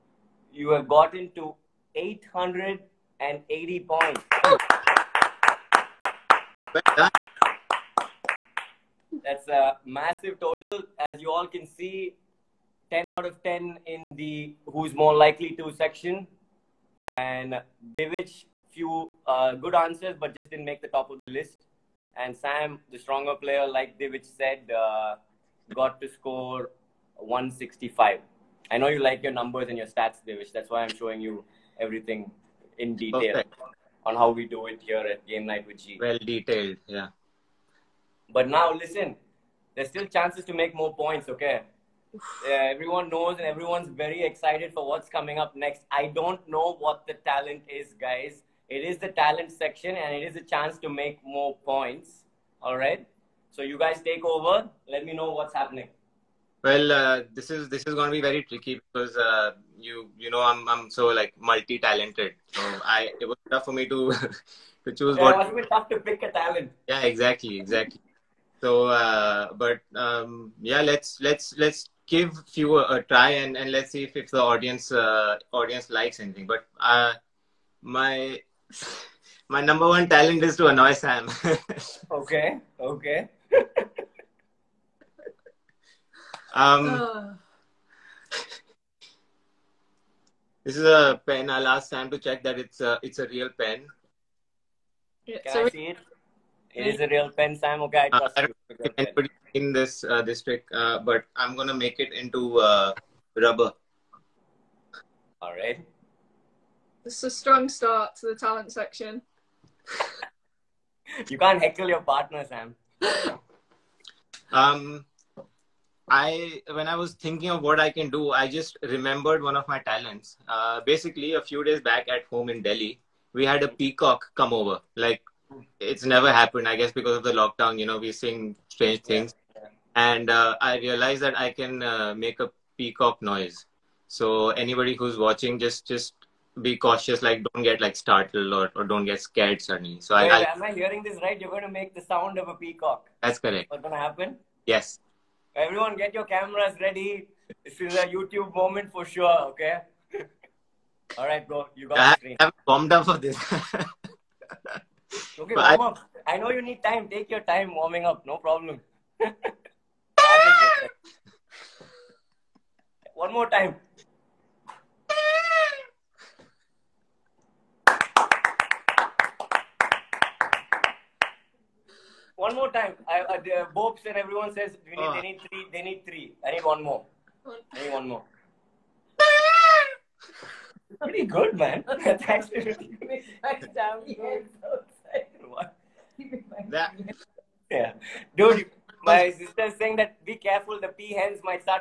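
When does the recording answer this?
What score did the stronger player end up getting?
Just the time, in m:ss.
0:27.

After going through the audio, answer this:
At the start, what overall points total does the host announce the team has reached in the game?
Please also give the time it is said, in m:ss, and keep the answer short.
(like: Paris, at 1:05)
880, at 0:01.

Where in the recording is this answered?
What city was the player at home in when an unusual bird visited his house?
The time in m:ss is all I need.
2:02.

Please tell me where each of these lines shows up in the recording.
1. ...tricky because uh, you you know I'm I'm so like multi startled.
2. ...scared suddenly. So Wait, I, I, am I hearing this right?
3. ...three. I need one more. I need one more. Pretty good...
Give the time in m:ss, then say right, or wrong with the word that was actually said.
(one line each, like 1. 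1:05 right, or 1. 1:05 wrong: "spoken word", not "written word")
1. 0:58 wrong: "talented", not "startled"
2. 2:19 right
3. 2:56 right.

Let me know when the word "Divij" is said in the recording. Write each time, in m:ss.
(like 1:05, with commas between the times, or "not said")
0:17, 0:23, 0:30.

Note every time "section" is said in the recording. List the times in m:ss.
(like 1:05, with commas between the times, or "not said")
0:15, 0:49, 1:48.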